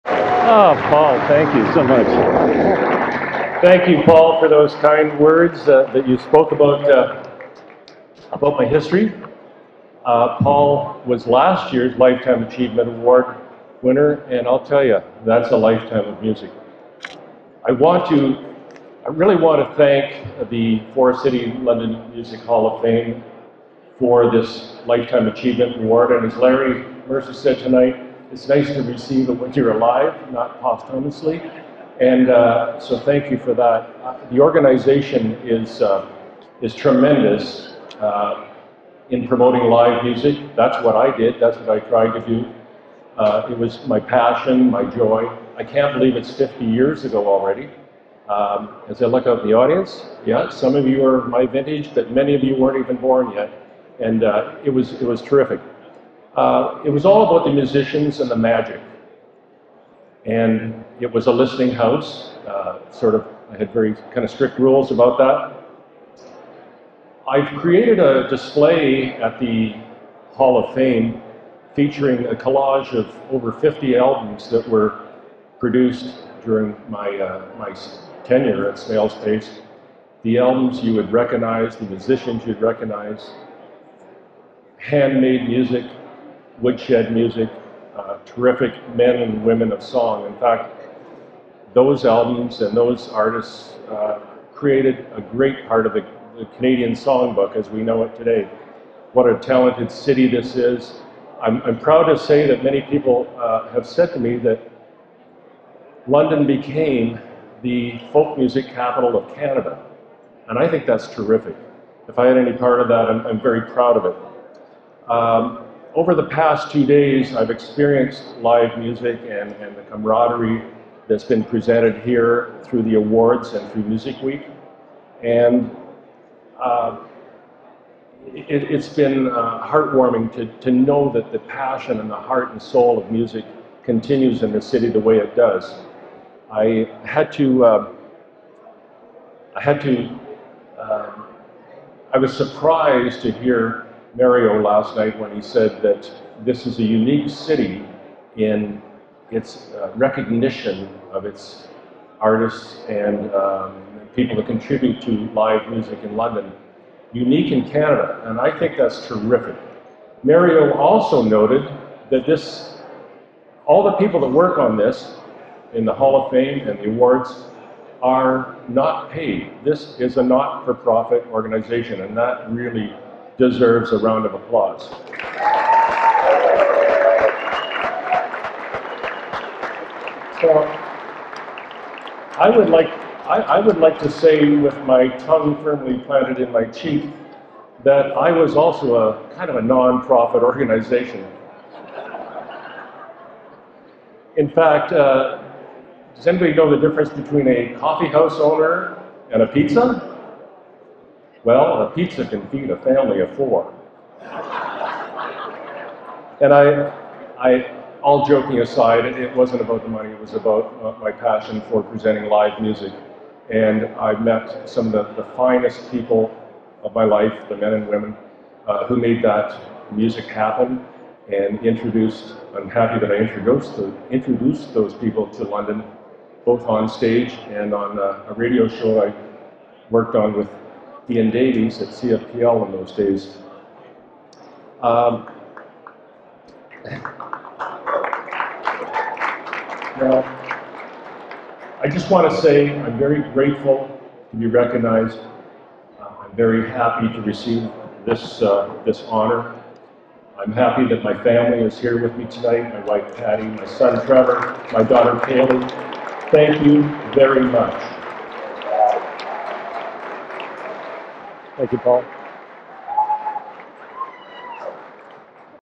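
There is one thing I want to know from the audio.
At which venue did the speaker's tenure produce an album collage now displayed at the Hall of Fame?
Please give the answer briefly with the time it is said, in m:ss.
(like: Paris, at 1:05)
Smales Pace, at 1:18.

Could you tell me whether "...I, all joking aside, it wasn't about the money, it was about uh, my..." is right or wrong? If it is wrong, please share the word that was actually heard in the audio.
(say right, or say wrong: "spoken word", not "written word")
right.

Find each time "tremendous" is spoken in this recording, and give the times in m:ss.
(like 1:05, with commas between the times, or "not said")
0:36.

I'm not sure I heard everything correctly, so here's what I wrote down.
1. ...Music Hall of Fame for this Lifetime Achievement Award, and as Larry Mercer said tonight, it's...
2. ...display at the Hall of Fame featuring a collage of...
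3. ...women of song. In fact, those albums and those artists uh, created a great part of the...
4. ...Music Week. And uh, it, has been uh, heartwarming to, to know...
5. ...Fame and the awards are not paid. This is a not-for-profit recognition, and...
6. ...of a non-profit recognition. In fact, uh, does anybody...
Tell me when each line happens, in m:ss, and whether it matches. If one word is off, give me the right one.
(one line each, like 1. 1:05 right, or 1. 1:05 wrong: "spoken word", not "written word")
1. 0:22 right
2. 1:08 right
3. 1:29 right
4. 2:03 right
5. 2:46 wrong: "organization", not "recognition"
6. 3:09 wrong: "organization", not "recognition".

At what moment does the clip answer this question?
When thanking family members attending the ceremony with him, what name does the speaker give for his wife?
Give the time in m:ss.
4:13.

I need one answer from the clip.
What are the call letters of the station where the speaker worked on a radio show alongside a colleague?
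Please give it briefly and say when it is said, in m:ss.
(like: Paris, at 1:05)
CFPL, at 3:51.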